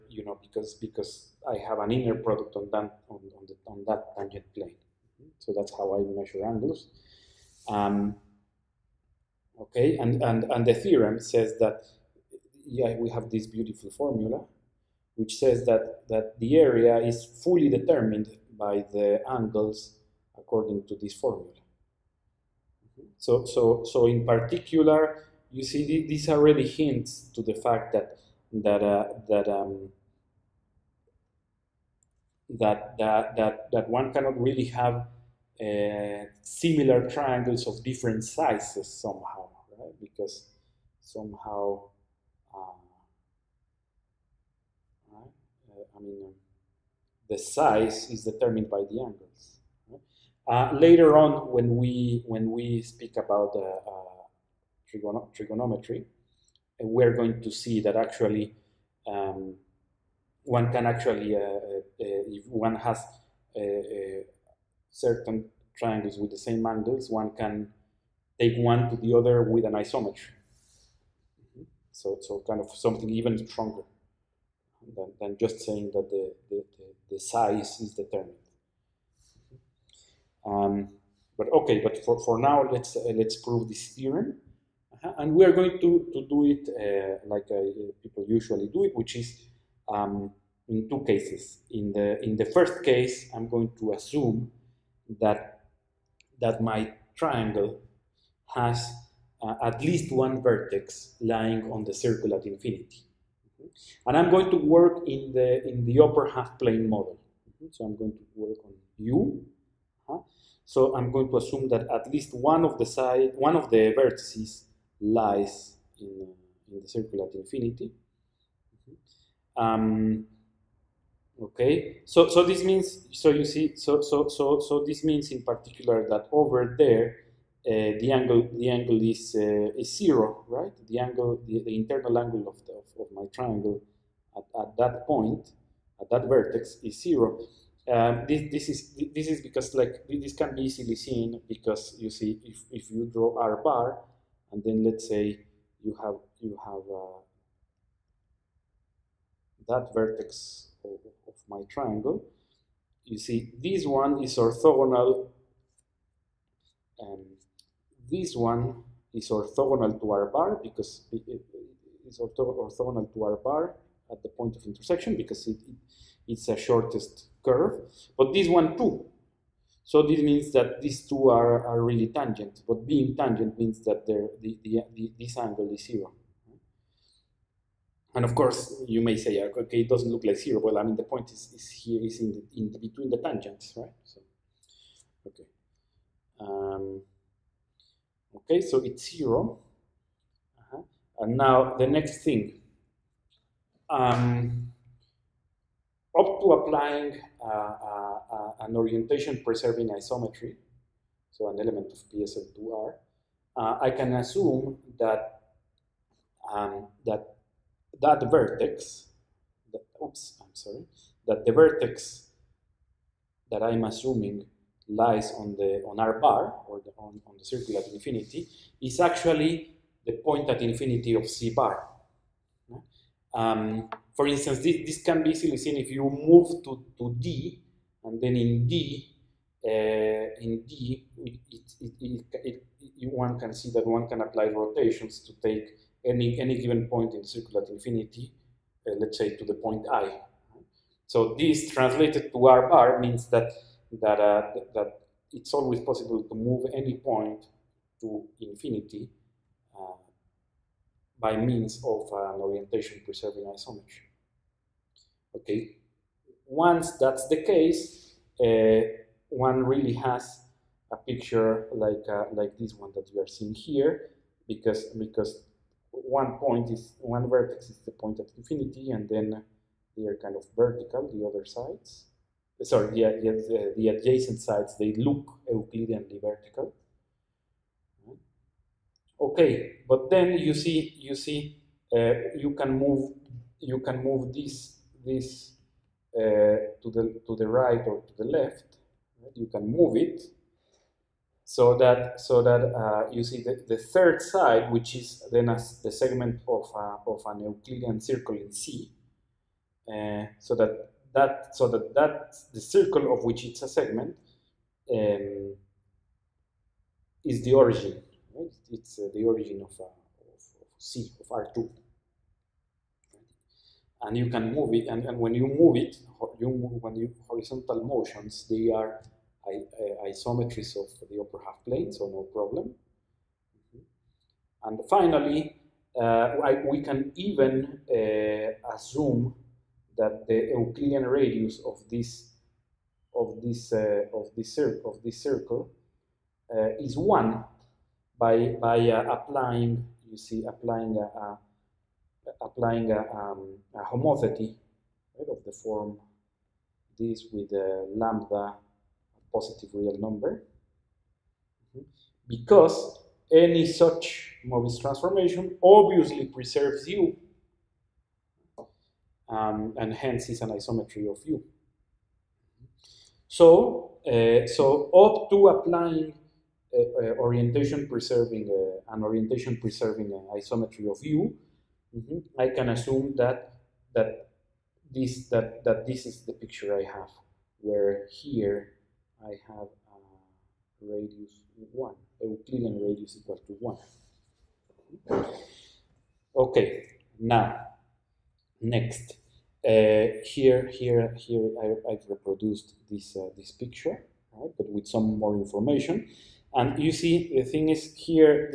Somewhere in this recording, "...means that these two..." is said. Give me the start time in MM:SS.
02:50.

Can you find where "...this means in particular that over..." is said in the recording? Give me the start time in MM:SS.
02:04.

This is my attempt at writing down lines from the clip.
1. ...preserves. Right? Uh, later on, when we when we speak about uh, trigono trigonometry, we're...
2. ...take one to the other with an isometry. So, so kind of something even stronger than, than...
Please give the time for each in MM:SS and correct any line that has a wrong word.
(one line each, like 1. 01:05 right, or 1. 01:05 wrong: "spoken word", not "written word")
1. 00:49 wrong: "angles", not "preserves"
2. 01:08 right.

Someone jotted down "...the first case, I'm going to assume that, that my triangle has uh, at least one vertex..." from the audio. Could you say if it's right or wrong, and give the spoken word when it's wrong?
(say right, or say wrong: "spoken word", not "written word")
right.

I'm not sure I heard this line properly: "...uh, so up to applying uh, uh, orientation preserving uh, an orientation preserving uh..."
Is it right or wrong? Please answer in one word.
right.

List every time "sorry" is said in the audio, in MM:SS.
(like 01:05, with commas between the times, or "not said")
03:30, 04:32.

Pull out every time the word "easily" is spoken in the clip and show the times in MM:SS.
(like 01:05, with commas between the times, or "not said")
02:20, 03:45.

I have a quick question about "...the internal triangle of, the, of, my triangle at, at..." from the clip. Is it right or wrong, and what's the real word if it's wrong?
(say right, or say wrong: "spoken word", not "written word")
wrong: "angle", not "triangle".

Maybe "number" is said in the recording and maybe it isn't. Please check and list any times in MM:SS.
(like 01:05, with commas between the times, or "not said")
05:49.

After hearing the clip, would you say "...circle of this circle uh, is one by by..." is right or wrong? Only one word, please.
right.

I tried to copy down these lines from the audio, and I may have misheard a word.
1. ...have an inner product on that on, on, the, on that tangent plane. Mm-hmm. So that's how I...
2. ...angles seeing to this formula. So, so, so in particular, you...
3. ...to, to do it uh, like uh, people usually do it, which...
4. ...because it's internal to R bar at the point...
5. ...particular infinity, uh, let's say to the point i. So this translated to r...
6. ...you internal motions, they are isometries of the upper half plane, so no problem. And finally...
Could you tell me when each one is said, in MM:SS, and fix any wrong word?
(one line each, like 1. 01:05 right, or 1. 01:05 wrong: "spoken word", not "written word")
1. 00:01 right
2. 00:19 wrong: "according", not "seeing"
3. 01:25 right
4. 02:40 wrong: "orthogonal", not "internal"
5. 03:57 wrong: "circular", not "particular"
6. 05:16 wrong: "horizontal", not "internal".